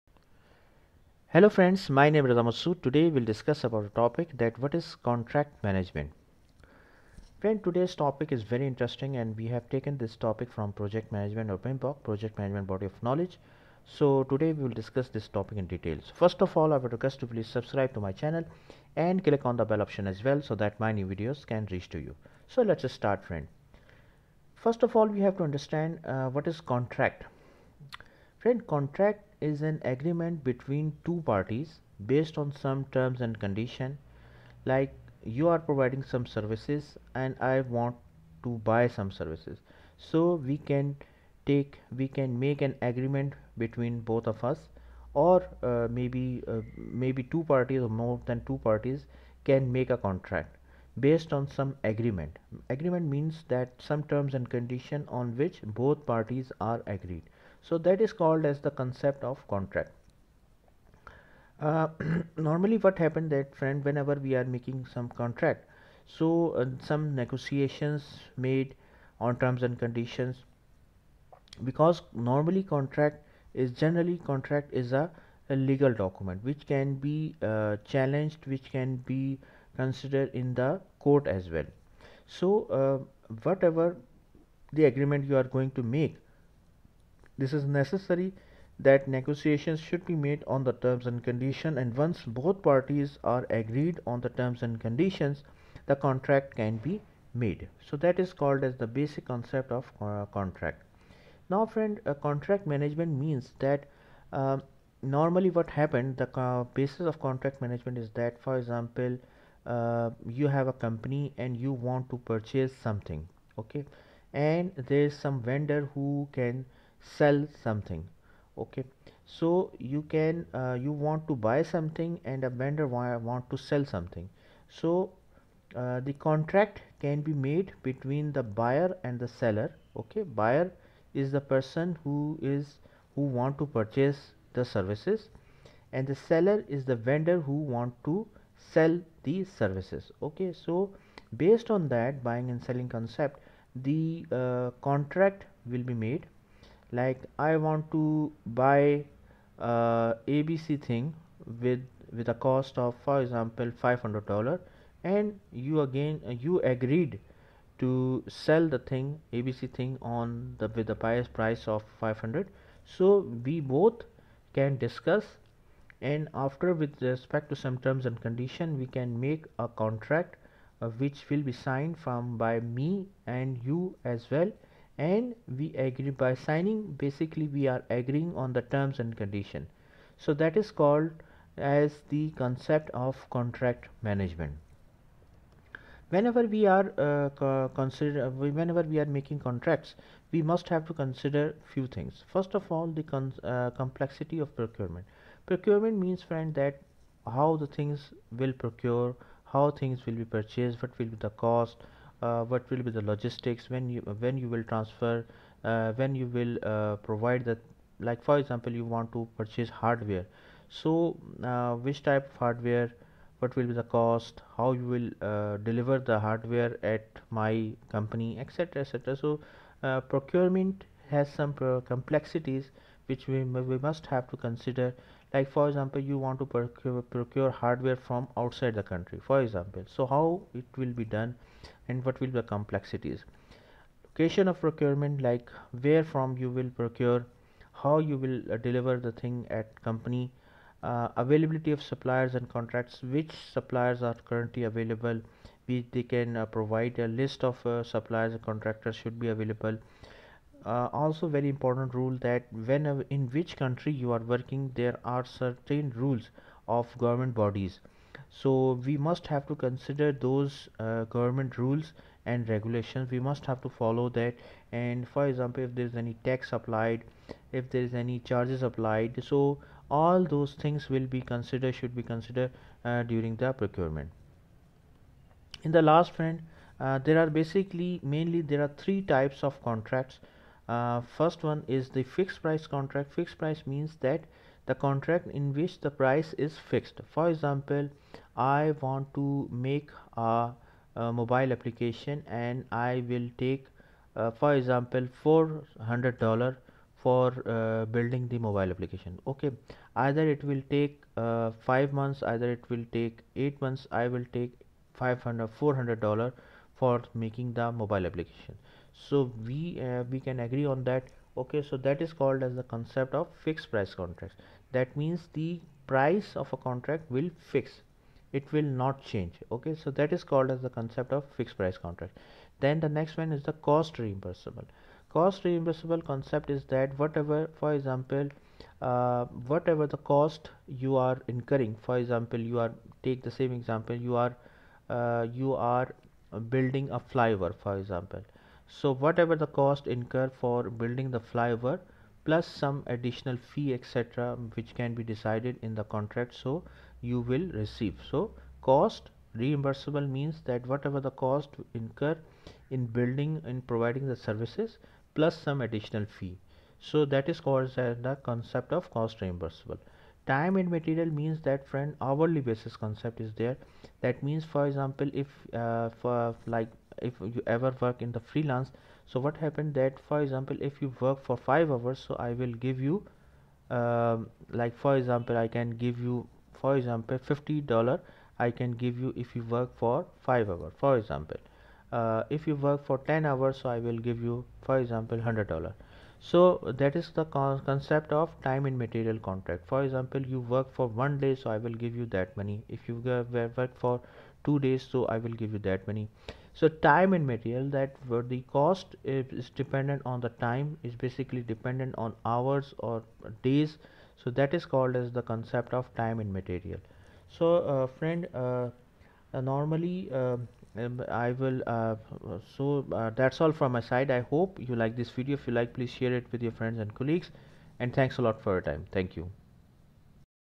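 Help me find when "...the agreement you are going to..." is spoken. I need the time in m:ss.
1:24.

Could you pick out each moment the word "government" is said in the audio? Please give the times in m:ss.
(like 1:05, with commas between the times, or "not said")
4:16, 4:21.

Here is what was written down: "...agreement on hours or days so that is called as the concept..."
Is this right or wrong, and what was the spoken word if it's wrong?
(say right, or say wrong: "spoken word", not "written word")
wrong: "dependent", not "agreement".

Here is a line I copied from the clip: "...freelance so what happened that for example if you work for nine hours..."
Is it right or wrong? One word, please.
wrong.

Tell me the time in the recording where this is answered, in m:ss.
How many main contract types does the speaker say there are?
4:38.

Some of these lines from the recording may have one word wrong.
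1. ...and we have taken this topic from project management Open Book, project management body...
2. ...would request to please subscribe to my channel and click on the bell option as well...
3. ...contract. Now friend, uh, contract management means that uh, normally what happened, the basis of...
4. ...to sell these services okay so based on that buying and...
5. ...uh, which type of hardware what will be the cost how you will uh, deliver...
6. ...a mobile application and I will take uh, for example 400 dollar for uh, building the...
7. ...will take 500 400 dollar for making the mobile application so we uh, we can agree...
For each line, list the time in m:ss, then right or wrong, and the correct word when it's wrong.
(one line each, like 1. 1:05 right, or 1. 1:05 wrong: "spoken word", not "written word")
1. 0:09 right
2. 0:16 right
3. 1:40 right
4. 2:18 right
5. 3:31 right
6. 4:50 right
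7. 5:04 right.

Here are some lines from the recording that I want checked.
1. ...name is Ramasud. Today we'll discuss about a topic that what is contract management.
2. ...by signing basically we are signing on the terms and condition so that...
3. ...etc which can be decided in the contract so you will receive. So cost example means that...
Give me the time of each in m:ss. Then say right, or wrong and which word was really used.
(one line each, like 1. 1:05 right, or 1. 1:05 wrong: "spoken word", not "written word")
1. 0:02 right
2. 2:56 wrong: "agreeing", not "signing"
3. 5:43 wrong: "reimbursable", not "example".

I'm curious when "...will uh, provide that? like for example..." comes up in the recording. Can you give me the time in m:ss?
3:26.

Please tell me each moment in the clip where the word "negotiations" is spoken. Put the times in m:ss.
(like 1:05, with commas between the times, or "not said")
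1:07, 1:29.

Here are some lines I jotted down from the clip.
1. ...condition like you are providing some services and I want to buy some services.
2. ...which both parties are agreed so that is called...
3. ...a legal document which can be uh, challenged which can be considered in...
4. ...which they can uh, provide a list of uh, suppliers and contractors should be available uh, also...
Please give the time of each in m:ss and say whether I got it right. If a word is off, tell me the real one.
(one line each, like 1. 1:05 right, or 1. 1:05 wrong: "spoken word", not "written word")
1. 0:33 right
2. 0:55 right
3. 1:15 right
4. 4:05 right.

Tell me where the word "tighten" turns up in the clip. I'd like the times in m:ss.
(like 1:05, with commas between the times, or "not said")
not said.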